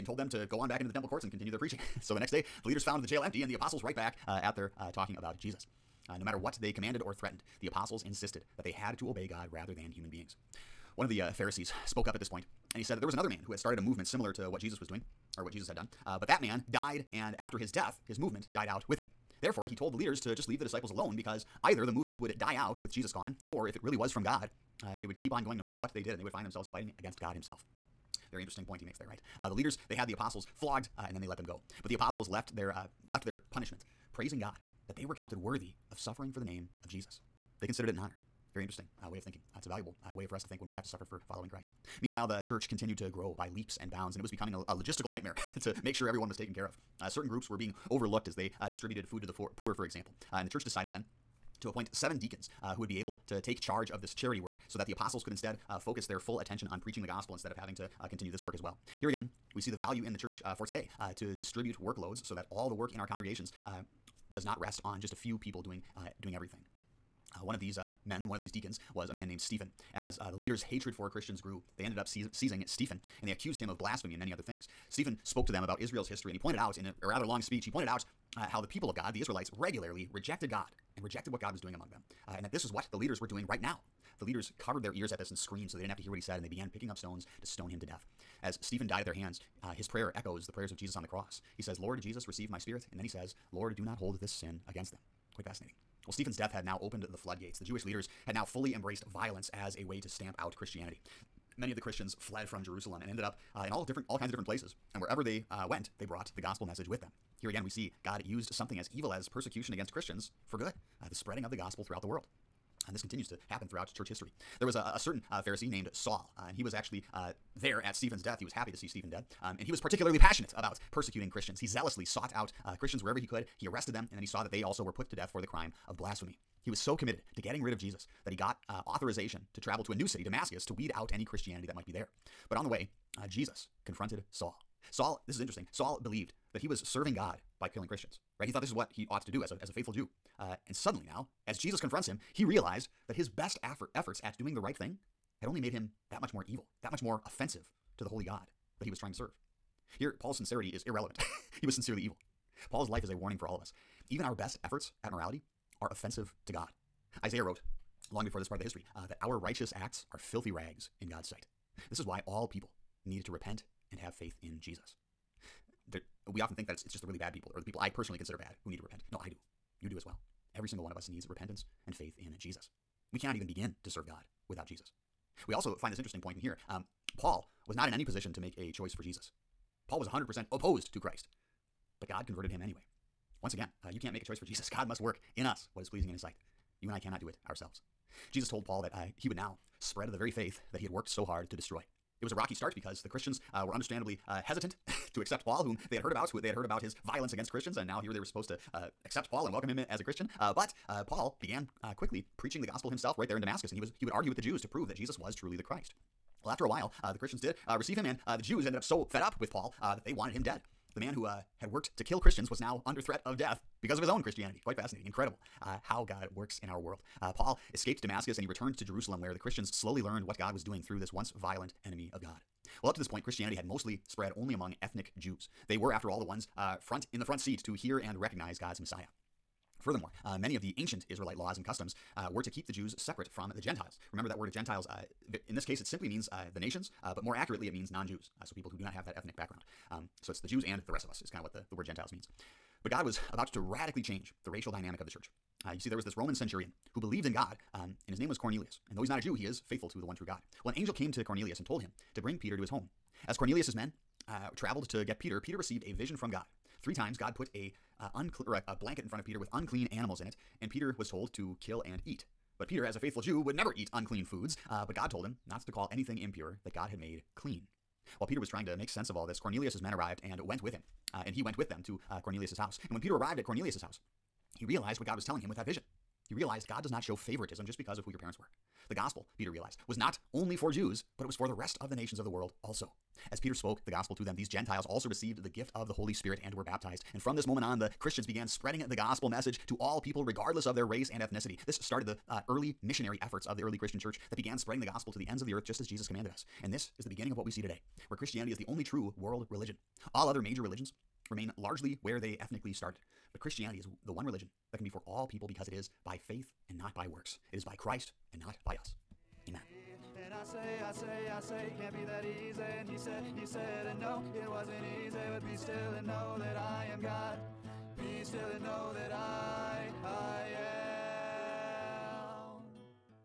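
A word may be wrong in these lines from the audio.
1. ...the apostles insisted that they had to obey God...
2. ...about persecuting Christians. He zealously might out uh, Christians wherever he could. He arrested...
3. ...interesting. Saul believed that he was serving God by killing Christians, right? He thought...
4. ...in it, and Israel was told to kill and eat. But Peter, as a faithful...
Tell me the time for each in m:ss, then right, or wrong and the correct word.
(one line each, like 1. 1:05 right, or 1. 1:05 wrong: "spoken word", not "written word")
1. 0:07 right
2. 2:00 wrong: "sought", not "might"
3. 2:15 right
4. 4:20 wrong: "Peter", not "Israel".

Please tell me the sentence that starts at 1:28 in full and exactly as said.
As Stephen died at their hands, uh, his prayer echoes the prayers of Jesus on the cross.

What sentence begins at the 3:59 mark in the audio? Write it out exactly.
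Um, so it's the Jews and the rest of us, is kind of what the, the word Gentiles means.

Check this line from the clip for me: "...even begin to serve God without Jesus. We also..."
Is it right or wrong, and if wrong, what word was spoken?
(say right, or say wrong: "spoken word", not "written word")
right.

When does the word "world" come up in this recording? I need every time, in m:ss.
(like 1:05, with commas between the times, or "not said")
1:52, 3:36, 4:42, 4:59.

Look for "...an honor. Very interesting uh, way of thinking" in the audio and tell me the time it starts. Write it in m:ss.
0:37.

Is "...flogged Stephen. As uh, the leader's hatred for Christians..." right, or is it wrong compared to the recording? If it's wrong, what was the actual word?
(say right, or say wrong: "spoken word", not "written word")
wrong: "named", not "flogged".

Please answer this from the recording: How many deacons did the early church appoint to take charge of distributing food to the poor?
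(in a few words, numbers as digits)
7.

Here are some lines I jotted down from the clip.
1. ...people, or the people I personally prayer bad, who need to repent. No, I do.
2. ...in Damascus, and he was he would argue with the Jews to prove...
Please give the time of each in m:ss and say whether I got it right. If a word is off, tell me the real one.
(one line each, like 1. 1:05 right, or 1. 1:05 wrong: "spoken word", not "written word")
1. 2:47 wrong: "consider", not "prayer"
2. 3:23 right.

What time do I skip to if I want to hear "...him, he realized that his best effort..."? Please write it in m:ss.
2:22.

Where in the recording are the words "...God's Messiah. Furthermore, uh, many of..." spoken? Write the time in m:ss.
3:48.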